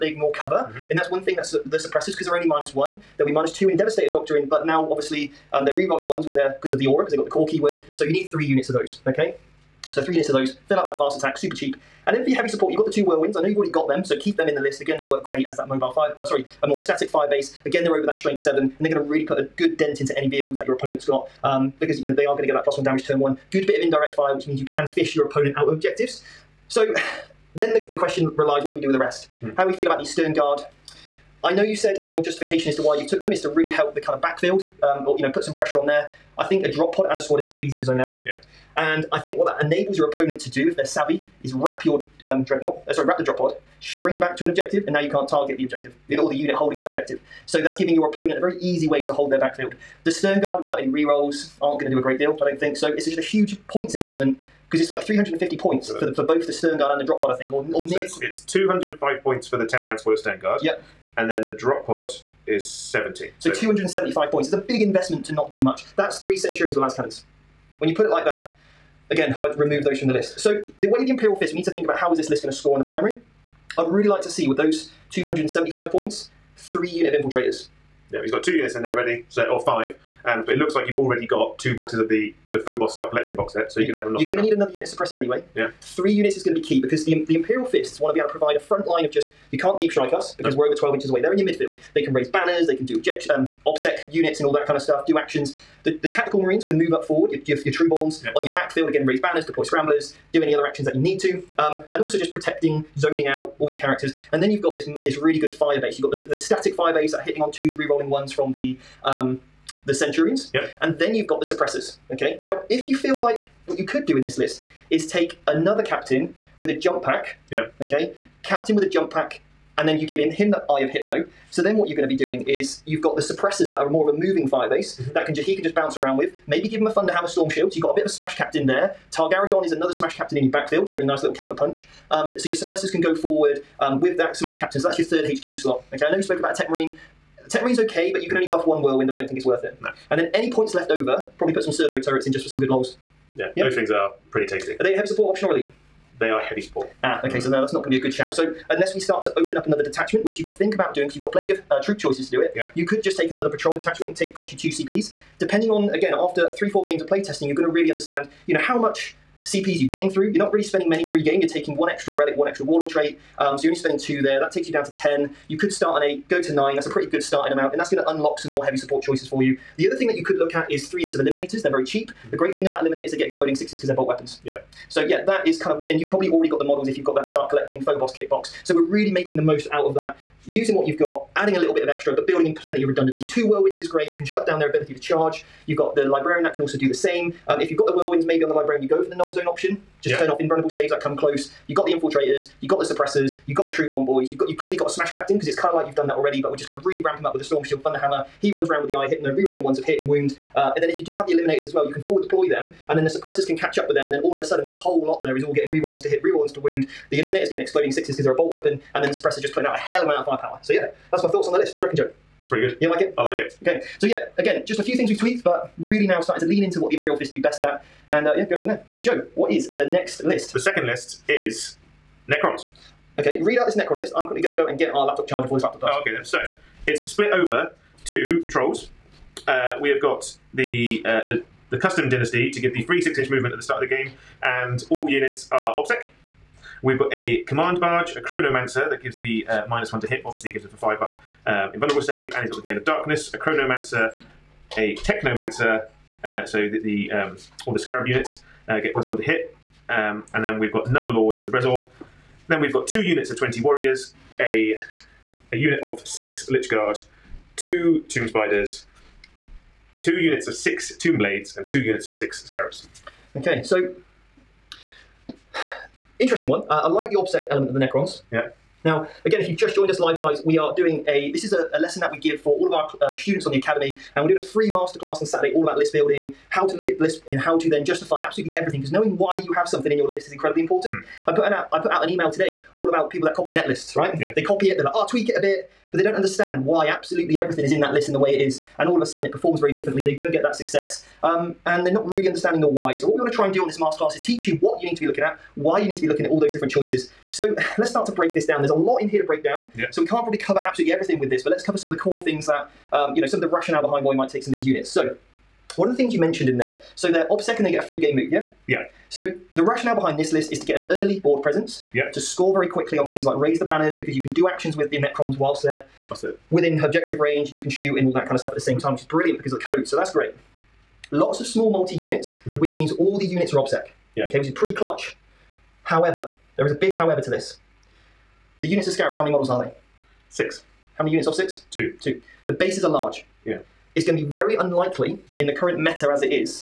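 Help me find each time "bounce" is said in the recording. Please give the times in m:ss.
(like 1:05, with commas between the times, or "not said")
2:05.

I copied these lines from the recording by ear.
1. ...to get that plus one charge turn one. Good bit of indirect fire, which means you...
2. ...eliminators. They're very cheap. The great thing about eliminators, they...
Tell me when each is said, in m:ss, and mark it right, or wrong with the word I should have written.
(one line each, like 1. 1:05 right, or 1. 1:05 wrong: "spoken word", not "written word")
1. 0:22 wrong: "damage", not "charge"
2. 2:51 right.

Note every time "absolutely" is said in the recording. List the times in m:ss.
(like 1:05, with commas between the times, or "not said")
4:38, 4:46, 5:00.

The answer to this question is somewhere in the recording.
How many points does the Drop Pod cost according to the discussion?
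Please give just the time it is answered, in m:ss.
1:02.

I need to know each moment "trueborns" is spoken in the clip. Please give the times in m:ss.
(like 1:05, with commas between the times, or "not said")
1:37, 3:13.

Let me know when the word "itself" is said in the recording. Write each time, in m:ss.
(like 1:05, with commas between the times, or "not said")
not said.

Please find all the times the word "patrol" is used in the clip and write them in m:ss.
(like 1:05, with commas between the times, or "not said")
2:33, 3:48.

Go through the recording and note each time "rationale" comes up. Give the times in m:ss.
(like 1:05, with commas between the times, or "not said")
5:03, 5:09.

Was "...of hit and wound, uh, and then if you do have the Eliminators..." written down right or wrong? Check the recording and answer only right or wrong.
right.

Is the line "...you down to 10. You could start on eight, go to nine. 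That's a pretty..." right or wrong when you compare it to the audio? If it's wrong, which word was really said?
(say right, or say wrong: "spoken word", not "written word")
right.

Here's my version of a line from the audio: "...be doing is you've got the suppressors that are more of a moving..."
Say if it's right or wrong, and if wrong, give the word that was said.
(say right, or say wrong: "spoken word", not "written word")
right.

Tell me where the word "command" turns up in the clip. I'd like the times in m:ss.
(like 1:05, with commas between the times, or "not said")
3:57.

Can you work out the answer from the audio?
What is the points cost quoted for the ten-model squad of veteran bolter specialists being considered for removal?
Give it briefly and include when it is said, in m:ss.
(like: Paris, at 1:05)
205, at 0:58.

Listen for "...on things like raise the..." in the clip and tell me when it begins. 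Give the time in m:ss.
5:12.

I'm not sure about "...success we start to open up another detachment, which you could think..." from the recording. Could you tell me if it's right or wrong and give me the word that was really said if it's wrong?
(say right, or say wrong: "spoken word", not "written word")
wrong: "unless", not "success".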